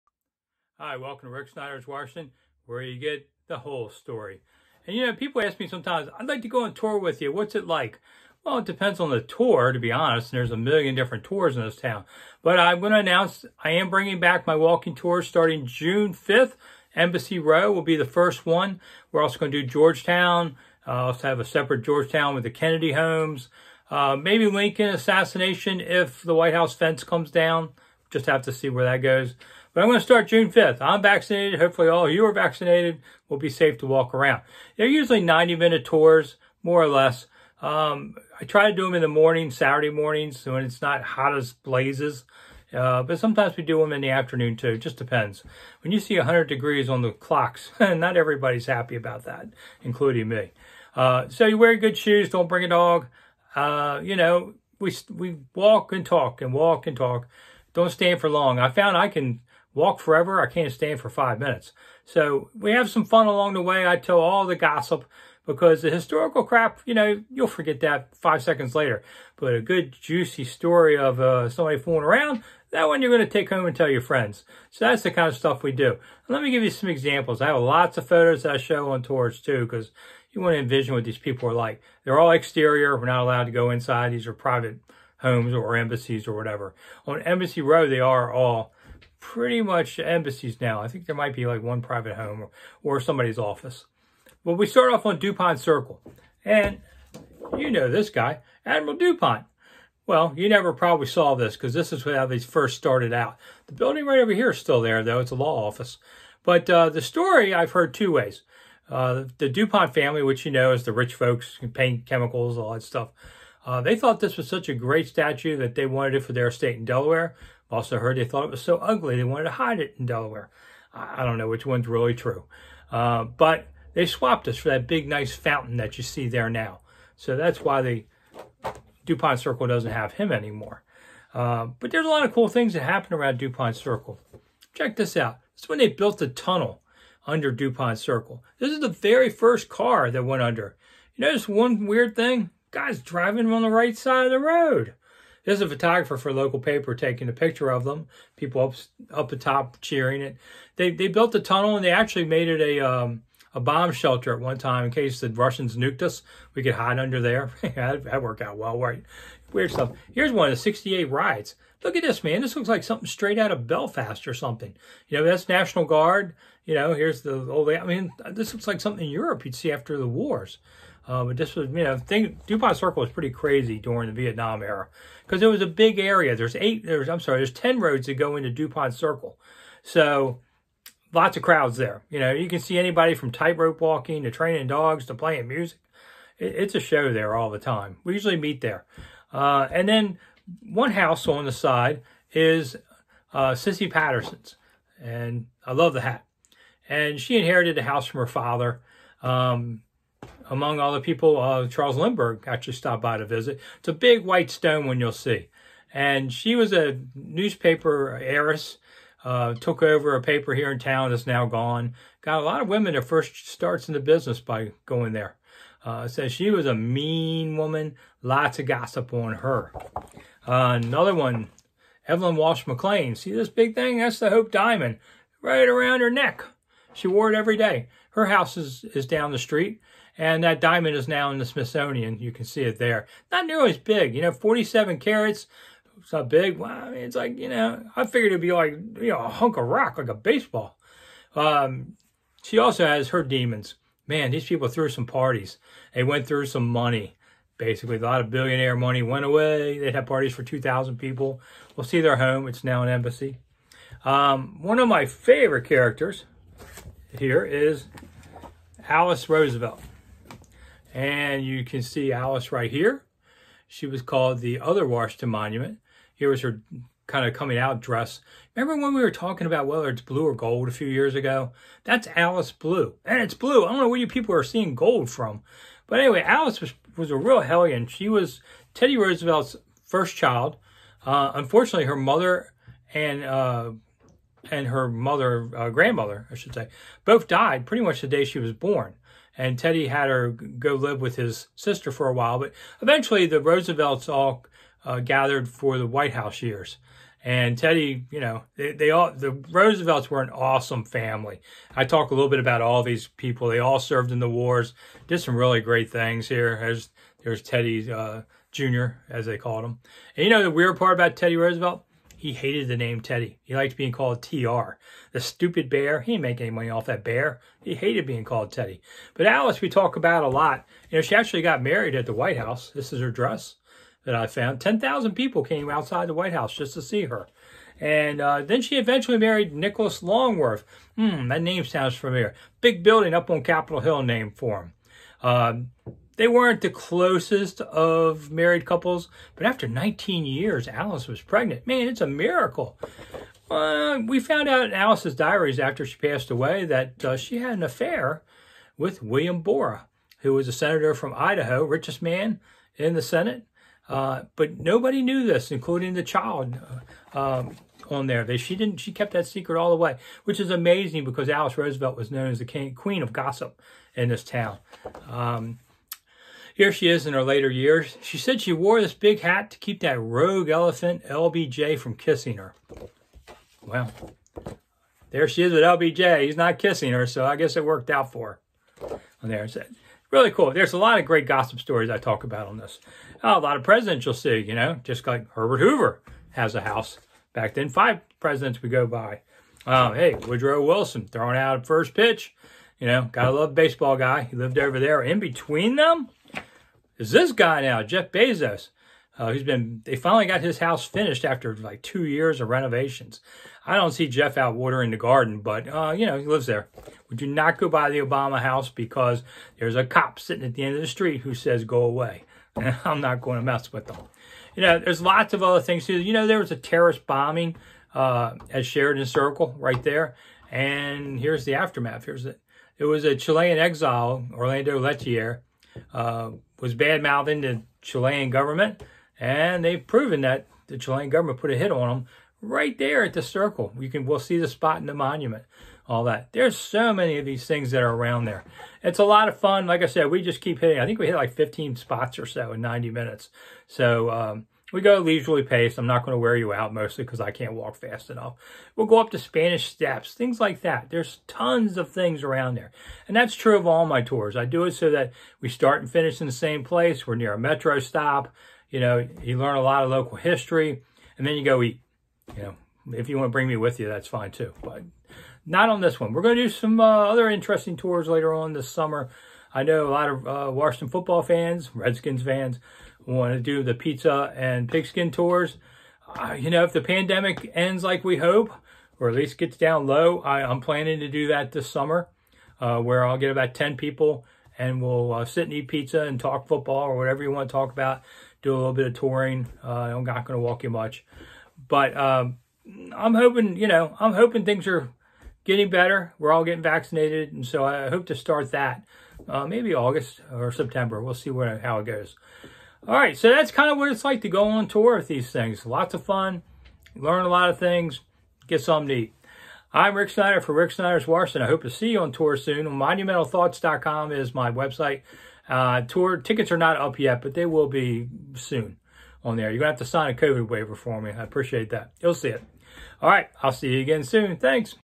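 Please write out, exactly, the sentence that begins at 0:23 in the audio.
Uh, maybe Lincoln assassination if the White House fence comes down.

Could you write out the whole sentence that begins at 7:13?
You can we'll see the spot in the monument, all that.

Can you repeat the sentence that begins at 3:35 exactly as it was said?
Uh, says she was a mean woman, lots of gossip on her.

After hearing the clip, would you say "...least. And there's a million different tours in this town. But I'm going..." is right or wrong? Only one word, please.
wrong.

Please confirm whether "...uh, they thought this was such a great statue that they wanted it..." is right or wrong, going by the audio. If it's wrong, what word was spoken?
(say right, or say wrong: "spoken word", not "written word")
right.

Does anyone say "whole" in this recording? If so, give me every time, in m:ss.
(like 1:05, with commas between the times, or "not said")
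0:03.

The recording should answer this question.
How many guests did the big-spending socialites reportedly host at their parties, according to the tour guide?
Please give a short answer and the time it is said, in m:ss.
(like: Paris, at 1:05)
2,000, at 4:10.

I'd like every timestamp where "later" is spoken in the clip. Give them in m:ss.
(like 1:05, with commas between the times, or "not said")
1:08, 6:07, 7:48.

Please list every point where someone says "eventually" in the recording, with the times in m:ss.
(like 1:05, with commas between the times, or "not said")
4:52, 5:28.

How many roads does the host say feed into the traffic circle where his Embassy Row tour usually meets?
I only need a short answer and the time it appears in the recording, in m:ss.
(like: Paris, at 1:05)
10, at 2:57.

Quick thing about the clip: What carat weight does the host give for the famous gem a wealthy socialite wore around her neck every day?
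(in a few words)
47 carats.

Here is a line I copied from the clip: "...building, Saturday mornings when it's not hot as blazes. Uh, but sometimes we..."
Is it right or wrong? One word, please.
wrong.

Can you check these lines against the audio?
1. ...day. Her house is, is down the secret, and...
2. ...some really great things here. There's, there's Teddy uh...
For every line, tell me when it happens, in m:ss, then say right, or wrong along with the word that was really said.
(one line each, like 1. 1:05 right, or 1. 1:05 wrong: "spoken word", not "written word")
1. 3:47 wrong: "street", not "secret"
2. 5:05 right.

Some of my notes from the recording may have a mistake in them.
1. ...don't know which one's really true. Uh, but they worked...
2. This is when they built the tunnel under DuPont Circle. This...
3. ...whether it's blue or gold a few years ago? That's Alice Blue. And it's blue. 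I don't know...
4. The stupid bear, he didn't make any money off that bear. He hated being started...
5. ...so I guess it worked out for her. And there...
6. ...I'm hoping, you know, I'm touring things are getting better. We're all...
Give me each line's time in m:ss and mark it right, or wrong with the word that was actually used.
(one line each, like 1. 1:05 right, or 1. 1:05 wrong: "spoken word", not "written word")
1. 2:01 wrong: "swapped", not "worked"
2. 2:15 right
3. 4:29 right
4. 5:15 wrong: "called", not "started"
5. 6:17 right
6. 8:12 wrong: "hoping", not "touring".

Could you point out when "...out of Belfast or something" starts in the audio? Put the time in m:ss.
2:43.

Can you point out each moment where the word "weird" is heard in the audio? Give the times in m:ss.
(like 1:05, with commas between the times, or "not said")
2:21, 2:39, 5:10.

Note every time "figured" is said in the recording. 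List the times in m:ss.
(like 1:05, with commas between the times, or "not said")
3:58.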